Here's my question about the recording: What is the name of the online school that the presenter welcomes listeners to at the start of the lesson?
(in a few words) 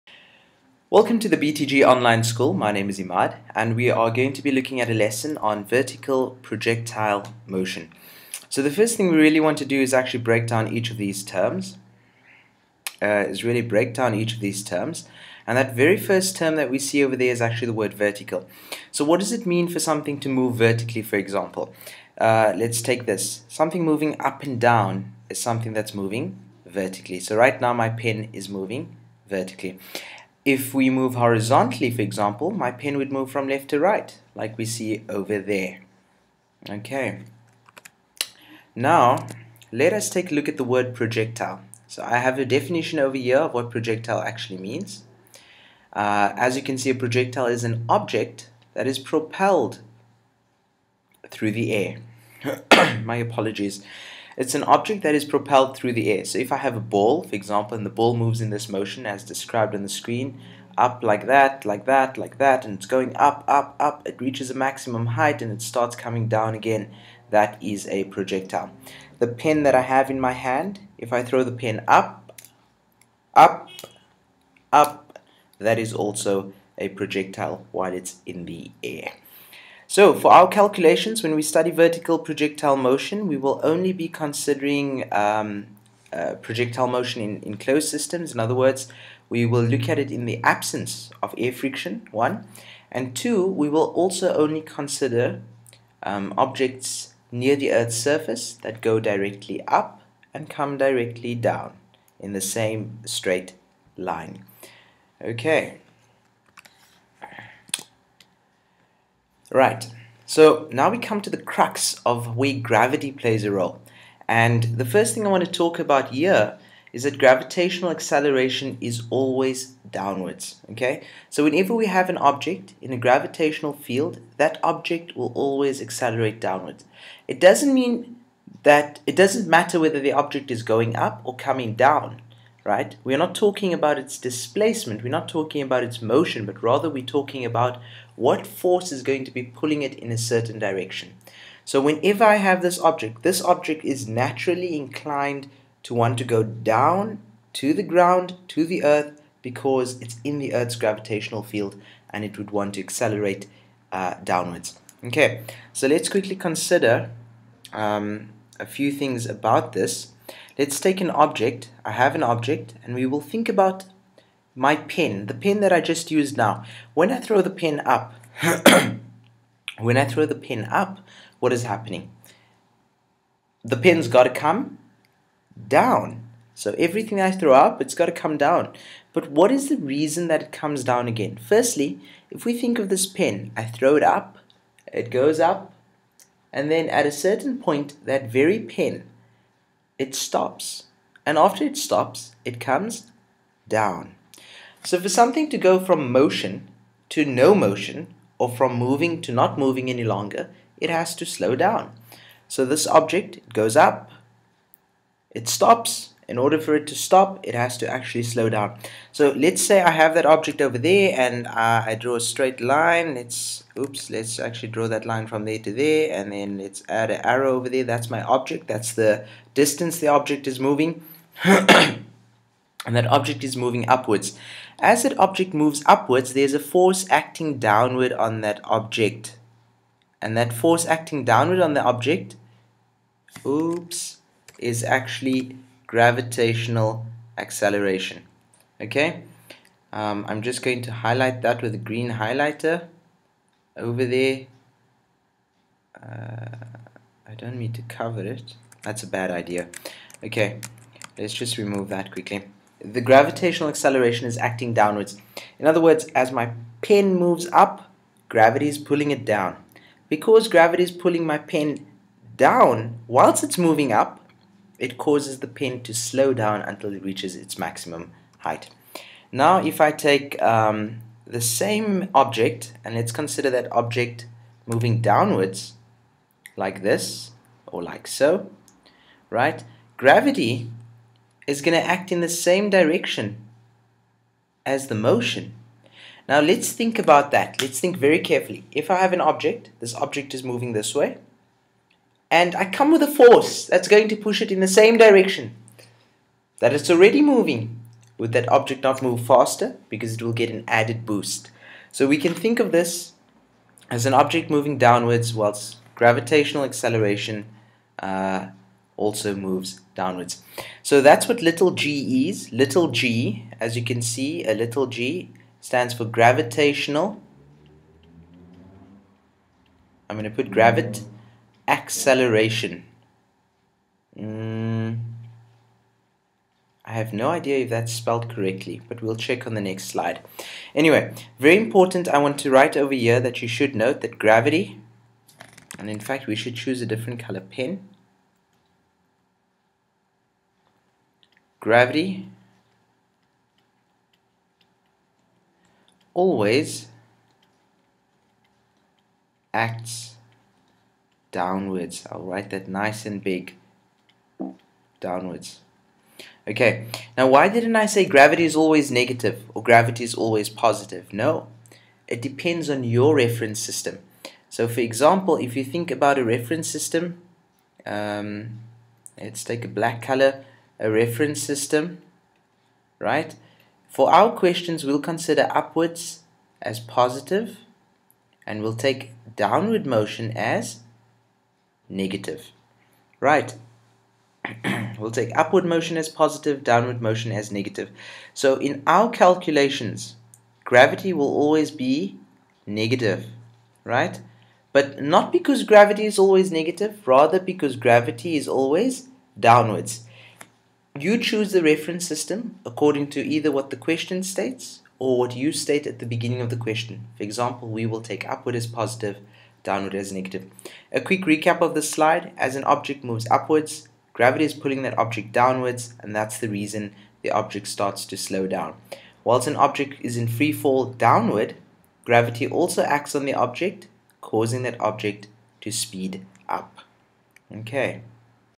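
BTG Online School.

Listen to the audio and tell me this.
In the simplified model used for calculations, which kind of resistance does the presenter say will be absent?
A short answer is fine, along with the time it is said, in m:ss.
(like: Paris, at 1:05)
air friction, at 1:31.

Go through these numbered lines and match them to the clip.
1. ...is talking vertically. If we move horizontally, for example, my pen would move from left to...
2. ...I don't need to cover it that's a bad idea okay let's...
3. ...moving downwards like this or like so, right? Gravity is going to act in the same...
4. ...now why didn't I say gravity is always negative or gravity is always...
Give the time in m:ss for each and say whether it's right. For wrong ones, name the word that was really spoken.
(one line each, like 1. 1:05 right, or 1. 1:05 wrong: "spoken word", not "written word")
1. 0:28 wrong: "moving", not "talking"
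2. 4:07 right
3. 4:34 right
4. 5:57 right.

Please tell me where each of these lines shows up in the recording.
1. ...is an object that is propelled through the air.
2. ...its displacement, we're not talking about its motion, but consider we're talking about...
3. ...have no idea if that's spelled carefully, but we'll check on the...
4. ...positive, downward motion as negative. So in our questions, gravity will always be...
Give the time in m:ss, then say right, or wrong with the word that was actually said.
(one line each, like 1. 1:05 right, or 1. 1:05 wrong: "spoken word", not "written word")
1. 0:47 right
2. 2:13 wrong: "rather", not "consider"
3. 5:26 wrong: "correctly", not "carefully"
4. 6:26 wrong: "calculations", not "questions".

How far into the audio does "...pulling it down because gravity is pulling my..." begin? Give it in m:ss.
4:18.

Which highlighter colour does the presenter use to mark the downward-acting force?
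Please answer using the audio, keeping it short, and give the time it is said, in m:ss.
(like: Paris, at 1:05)
green, at 4:01.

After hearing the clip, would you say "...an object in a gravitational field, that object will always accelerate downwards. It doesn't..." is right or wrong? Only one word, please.
right.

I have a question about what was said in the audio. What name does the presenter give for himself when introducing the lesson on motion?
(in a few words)
Imad.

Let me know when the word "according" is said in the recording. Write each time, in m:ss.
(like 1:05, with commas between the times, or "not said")
6:42.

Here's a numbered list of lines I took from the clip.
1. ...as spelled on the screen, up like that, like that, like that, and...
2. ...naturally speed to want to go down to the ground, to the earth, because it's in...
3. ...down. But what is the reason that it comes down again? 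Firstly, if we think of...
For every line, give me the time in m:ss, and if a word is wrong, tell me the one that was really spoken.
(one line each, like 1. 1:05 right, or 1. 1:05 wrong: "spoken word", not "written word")
1. 0:59 wrong: "described", not "spelled"
2. 2:24 wrong: "inclined", not "speed"
3. 2:58 right.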